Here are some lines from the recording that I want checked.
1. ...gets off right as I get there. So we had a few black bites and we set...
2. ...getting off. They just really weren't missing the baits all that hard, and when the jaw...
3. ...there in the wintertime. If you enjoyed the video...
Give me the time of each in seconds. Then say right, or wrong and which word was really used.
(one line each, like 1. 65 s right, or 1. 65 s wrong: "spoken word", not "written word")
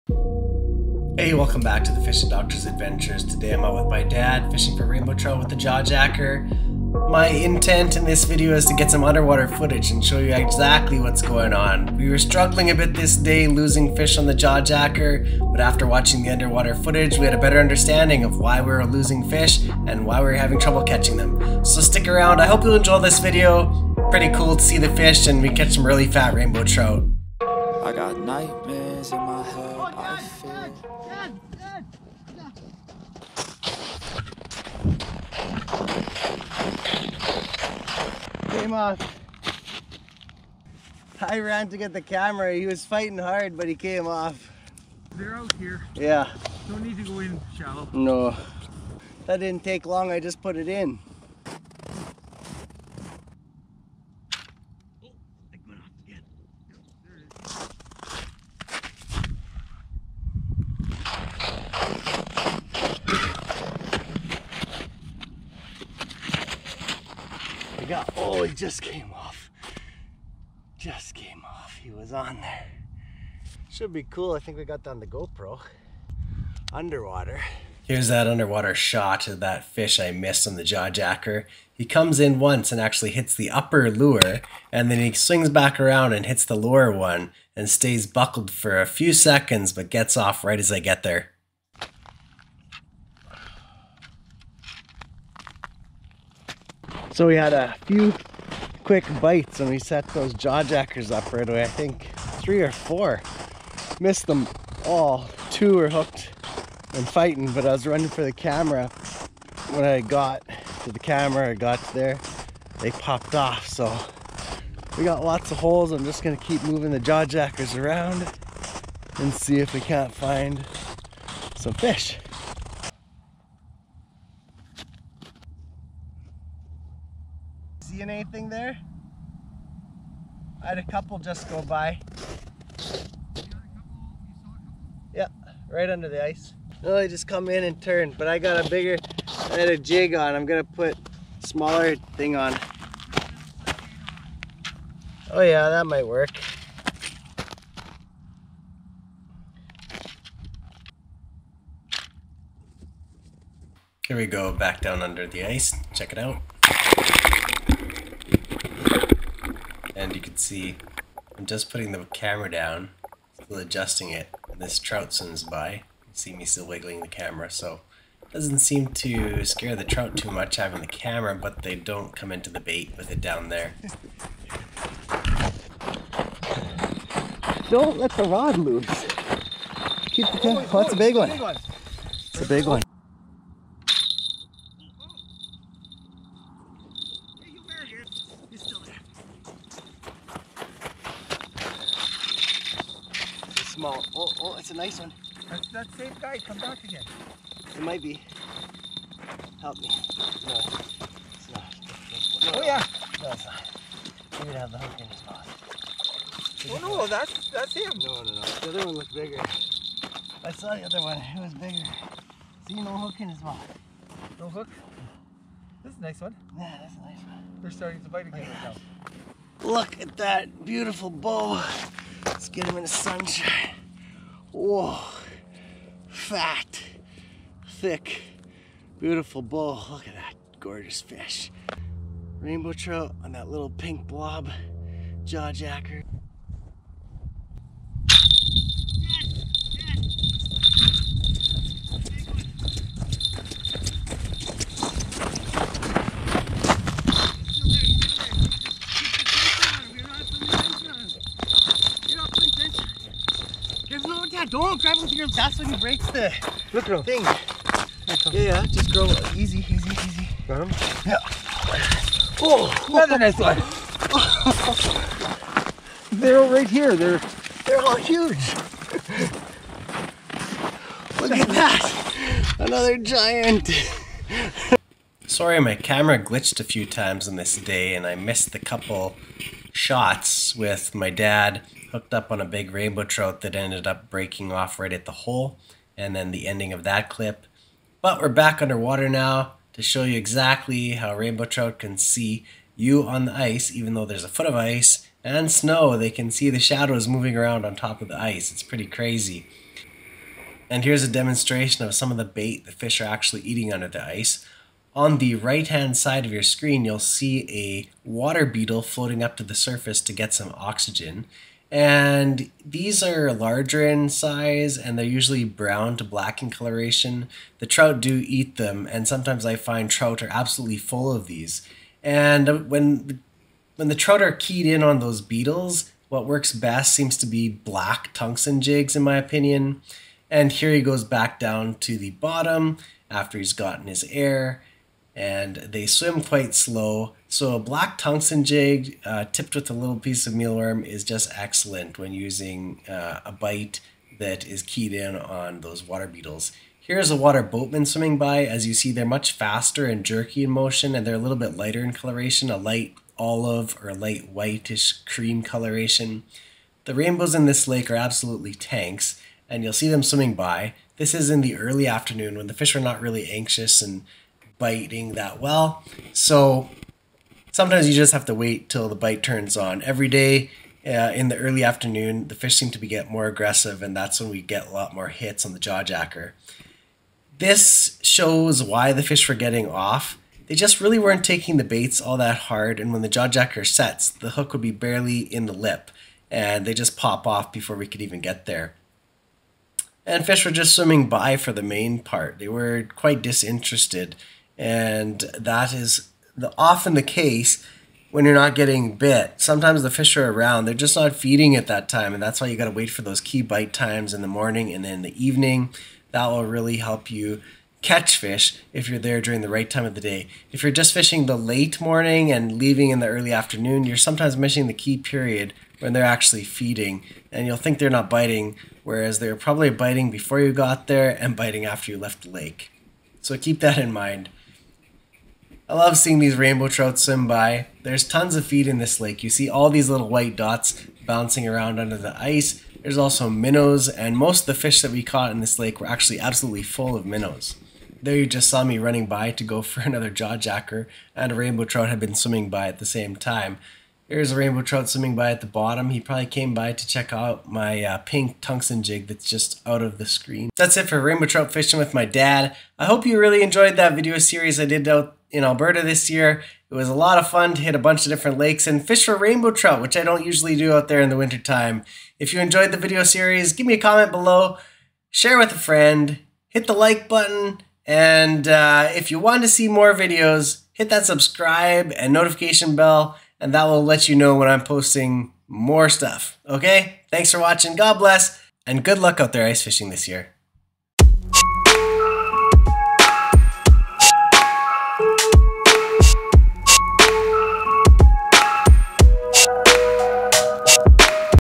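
1. 89 s wrong: "quick", not "black"
2. 379 s wrong: "taking", not "missing"
3. 460 s right.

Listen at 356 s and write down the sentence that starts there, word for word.
The rainbows in this lake are absolutely tanks, and you'll see them swimming by.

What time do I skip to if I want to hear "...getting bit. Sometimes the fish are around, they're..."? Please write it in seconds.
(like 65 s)
398 s.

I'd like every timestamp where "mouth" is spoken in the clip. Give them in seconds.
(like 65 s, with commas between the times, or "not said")
205 s, 213 s.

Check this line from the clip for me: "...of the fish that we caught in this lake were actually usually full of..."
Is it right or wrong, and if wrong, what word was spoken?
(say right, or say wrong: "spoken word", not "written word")
wrong: "absolutely", not "usually".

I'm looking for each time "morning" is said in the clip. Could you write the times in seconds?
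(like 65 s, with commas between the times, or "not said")
404 s, 411 s.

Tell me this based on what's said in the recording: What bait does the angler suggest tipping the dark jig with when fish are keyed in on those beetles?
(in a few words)
mealworm.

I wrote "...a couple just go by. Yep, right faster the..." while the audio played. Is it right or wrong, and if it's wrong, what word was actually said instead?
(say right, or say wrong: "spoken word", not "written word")
wrong: "under", not "faster".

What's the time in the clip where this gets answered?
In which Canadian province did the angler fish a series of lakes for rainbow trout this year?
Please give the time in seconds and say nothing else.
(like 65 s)
455 s.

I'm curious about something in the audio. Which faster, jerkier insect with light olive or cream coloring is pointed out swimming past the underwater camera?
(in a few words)
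water boatman.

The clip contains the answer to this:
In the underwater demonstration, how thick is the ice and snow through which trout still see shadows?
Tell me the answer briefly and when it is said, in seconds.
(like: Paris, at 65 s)
a foot, at 294 s.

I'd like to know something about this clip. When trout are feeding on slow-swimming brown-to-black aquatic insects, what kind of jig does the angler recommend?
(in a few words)
black tungsten jigs.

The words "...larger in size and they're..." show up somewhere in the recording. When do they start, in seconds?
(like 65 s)
313 s.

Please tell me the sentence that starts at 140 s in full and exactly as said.
I'm gonna put smaller thing on.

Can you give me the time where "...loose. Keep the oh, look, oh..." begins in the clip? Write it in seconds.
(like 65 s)
178 s.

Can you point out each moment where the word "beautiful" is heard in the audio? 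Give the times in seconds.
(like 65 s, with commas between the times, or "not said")
220 s, 228 s.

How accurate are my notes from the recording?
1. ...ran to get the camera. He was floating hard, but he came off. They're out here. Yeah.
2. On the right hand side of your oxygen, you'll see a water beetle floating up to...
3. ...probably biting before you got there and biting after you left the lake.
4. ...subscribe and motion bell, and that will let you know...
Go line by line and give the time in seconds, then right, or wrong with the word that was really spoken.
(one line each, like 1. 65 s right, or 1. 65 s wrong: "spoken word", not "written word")
1. 41 s wrong: "fighting", not "floating"
2. 304 s wrong: "screen", not "oxygen"
3. 419 s right
4. 471 s wrong: "notification", not "motion".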